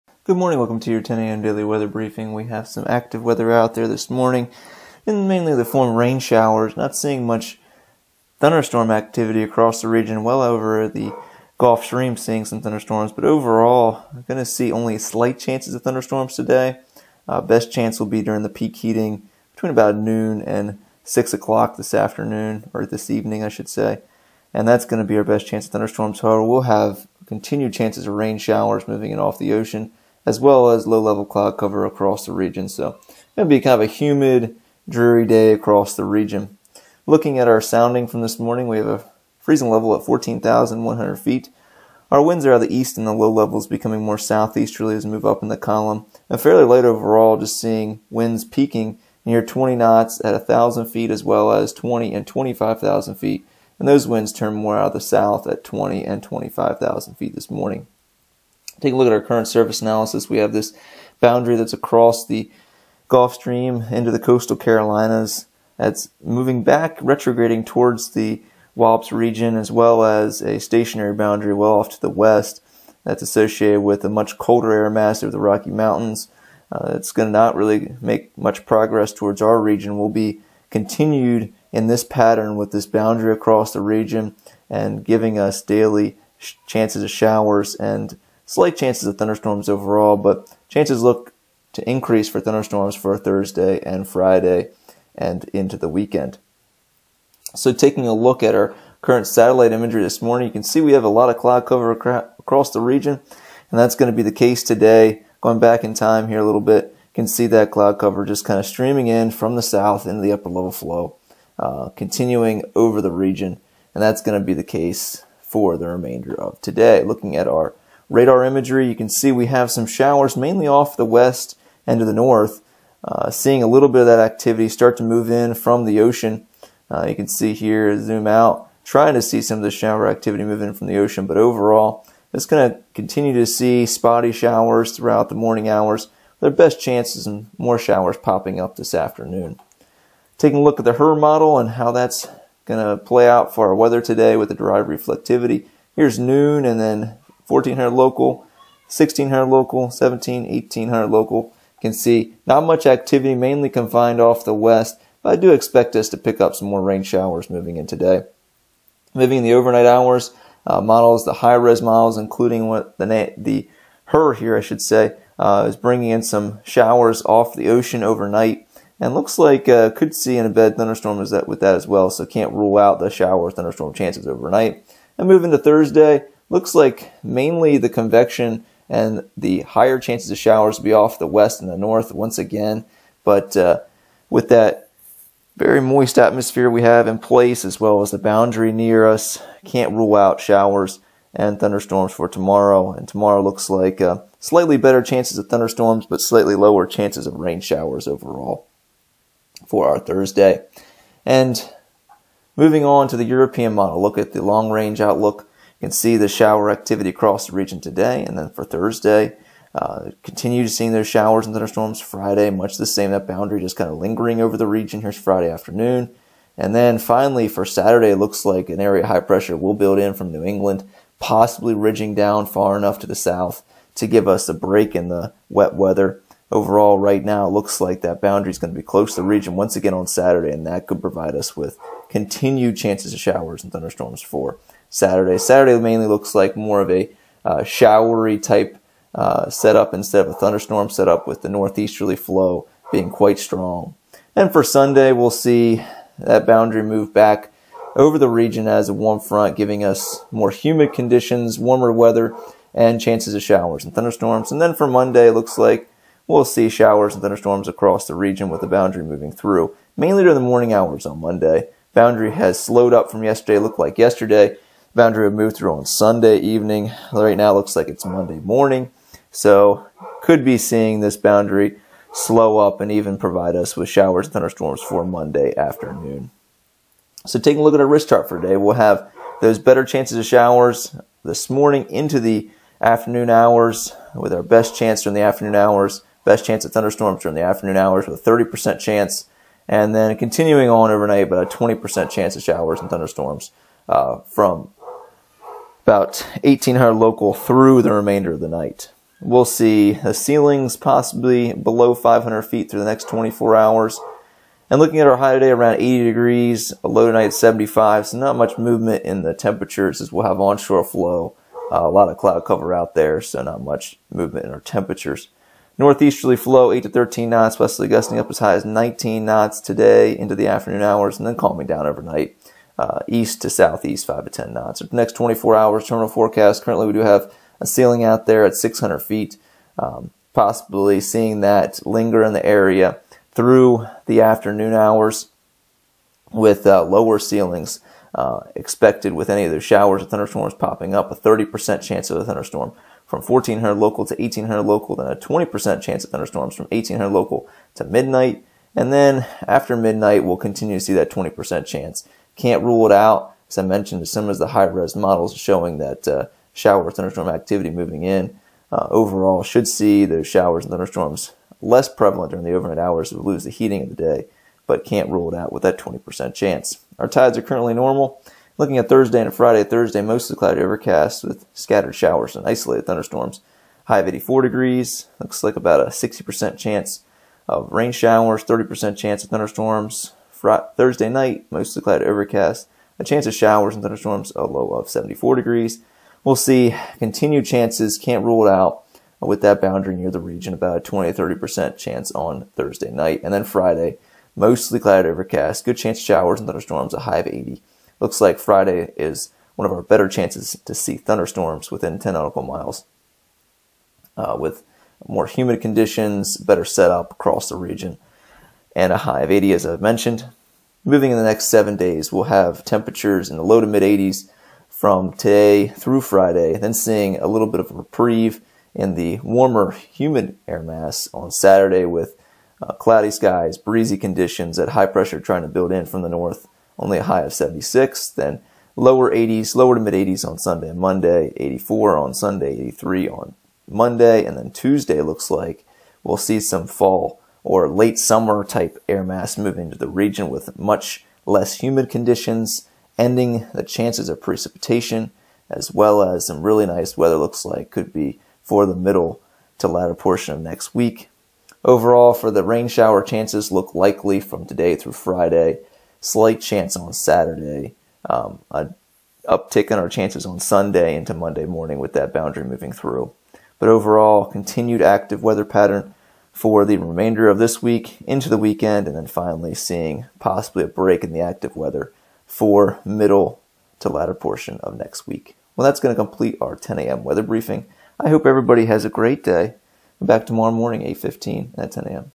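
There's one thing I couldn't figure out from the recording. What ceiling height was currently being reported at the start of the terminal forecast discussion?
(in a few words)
600 feet.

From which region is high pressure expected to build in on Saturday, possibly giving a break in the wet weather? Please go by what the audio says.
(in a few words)
New England.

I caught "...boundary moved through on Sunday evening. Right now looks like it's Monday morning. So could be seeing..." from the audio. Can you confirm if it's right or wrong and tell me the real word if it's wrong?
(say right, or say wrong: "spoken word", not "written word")
right.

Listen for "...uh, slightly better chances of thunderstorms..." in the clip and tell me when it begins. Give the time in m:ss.
3:14.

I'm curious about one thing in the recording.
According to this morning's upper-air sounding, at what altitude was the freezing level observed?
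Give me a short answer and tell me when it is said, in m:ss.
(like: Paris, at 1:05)
14,100 feet, at 0:40.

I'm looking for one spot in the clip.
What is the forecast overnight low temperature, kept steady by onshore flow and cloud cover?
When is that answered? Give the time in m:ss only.
5:07.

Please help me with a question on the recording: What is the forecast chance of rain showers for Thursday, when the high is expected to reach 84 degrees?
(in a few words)
60%.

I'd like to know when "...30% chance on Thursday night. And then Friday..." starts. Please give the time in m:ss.
6:31.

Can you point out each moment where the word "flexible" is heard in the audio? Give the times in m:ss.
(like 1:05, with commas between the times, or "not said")
not said.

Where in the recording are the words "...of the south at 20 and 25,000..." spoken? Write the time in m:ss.
0:54.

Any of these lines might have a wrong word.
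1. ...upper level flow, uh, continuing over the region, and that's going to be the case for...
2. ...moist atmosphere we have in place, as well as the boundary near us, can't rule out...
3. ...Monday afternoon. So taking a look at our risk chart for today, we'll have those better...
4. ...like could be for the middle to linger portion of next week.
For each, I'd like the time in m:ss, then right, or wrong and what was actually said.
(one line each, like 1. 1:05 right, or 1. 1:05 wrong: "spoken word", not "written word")
1. 1:50 right
2. 3:05 right
3. 4:35 right
4. 7:27 wrong: "latter", not "linger".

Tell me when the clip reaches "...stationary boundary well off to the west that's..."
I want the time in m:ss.
1:10.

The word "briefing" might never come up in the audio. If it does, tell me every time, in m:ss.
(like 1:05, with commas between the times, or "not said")
0:01, 7:57.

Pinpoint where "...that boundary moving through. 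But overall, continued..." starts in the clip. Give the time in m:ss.
7:41.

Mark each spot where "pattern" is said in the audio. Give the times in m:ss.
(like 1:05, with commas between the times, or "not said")
1:22, 7:45.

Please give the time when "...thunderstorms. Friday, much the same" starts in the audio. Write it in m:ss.
3:31.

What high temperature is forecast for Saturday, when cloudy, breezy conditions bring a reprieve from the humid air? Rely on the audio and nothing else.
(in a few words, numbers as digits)
76.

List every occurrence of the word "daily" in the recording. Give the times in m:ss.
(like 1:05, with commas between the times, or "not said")
0:01, 1:25.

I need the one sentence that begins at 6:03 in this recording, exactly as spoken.
we lose the heating of the day, but can't rule it out with that 20% chance.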